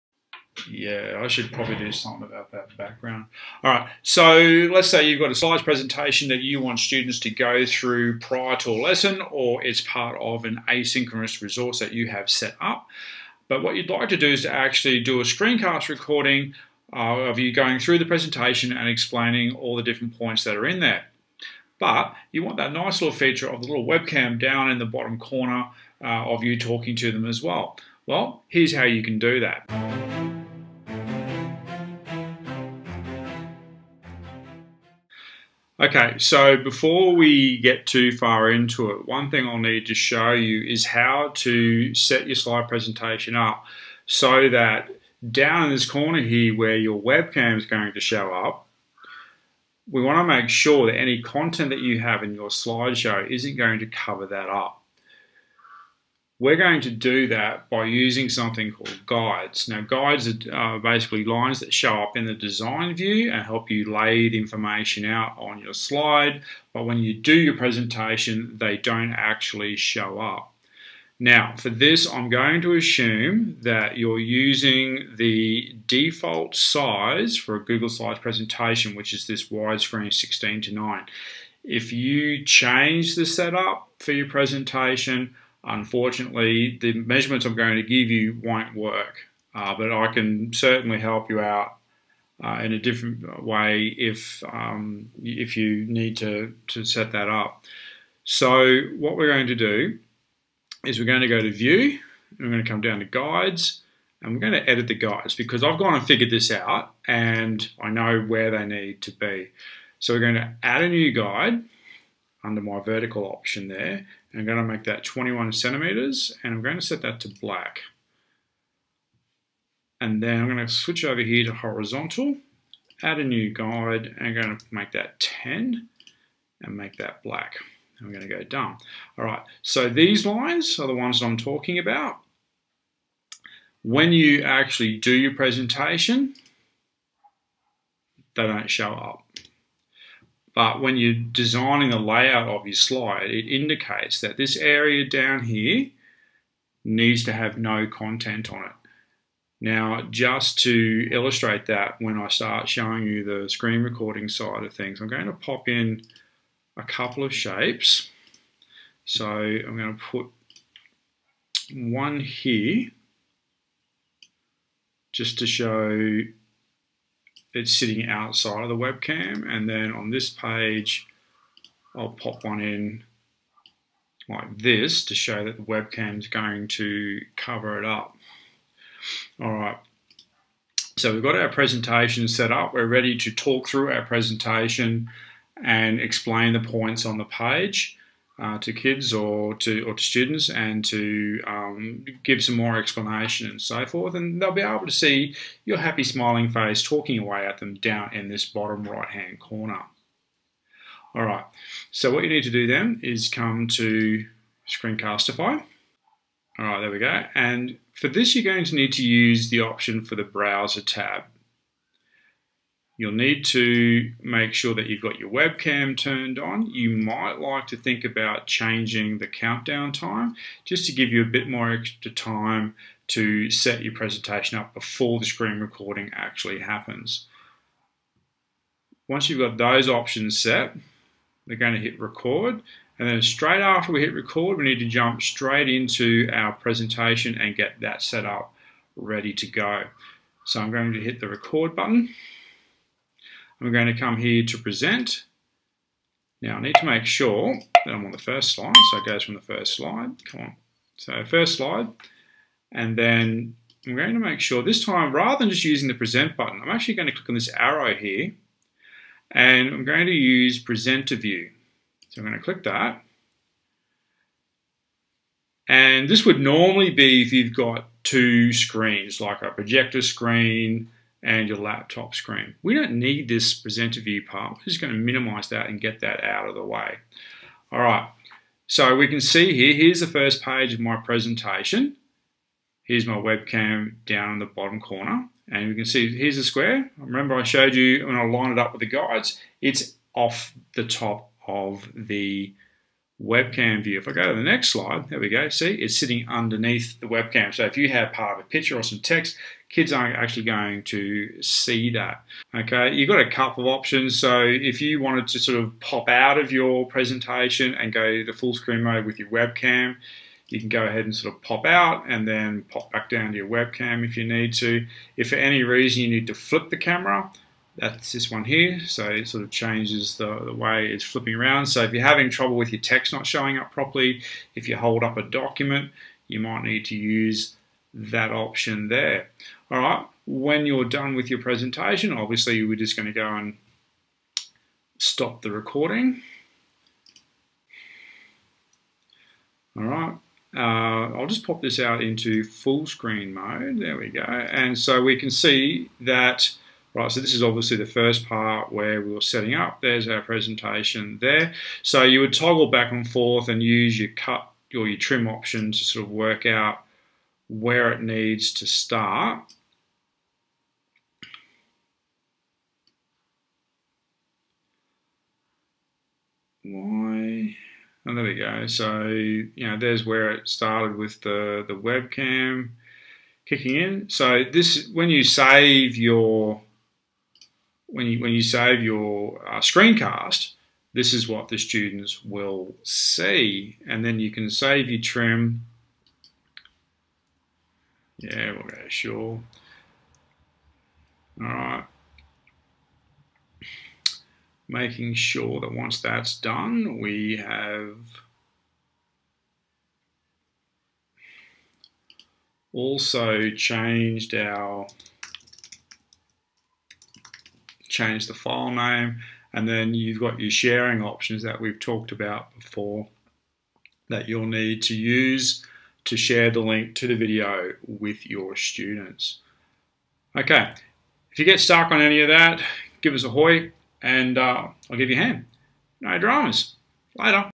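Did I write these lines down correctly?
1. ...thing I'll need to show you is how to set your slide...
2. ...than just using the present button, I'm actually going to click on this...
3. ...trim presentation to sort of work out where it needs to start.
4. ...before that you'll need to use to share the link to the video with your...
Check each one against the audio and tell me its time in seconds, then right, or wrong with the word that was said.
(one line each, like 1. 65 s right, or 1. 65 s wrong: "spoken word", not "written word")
1. 39 s right
2. 255 s right
3. 354 s wrong: "option", not "presentation"
4. 412 s right.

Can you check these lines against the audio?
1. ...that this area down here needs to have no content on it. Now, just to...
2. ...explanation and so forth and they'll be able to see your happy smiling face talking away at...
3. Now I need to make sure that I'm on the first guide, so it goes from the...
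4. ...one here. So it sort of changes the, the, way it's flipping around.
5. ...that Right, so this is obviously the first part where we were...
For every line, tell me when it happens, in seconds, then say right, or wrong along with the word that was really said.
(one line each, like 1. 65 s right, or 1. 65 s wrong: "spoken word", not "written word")
1. 144 s right
2. 192 s right
3. 246 s wrong: "slide", not "guide"
4. 318 s right
5. 346 s right.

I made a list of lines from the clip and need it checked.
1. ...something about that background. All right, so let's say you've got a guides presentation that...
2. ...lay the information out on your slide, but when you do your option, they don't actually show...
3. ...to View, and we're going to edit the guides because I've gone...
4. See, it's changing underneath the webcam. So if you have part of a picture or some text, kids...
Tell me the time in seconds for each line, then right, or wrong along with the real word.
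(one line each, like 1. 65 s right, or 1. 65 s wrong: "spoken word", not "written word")
1. 1 s wrong: "slides", not "guides"
2. 63 s wrong: "presentation", not "option"
3. 102 s wrong: "Guides", not "View"
4. 295 s wrong: "sitting", not "changing".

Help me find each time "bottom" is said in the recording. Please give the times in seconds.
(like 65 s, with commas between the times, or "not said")
24 s, 198 s, 284 s.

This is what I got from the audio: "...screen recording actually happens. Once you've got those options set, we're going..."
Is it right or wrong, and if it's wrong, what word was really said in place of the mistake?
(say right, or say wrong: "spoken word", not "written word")
right.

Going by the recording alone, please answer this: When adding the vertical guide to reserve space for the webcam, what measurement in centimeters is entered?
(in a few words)
21 centimeters.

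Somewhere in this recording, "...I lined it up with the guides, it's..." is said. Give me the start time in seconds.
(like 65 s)
288 s.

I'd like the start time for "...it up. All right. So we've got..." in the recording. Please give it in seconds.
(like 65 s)
177 s.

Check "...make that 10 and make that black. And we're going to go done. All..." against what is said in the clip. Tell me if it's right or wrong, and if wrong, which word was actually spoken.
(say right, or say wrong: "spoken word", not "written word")
right.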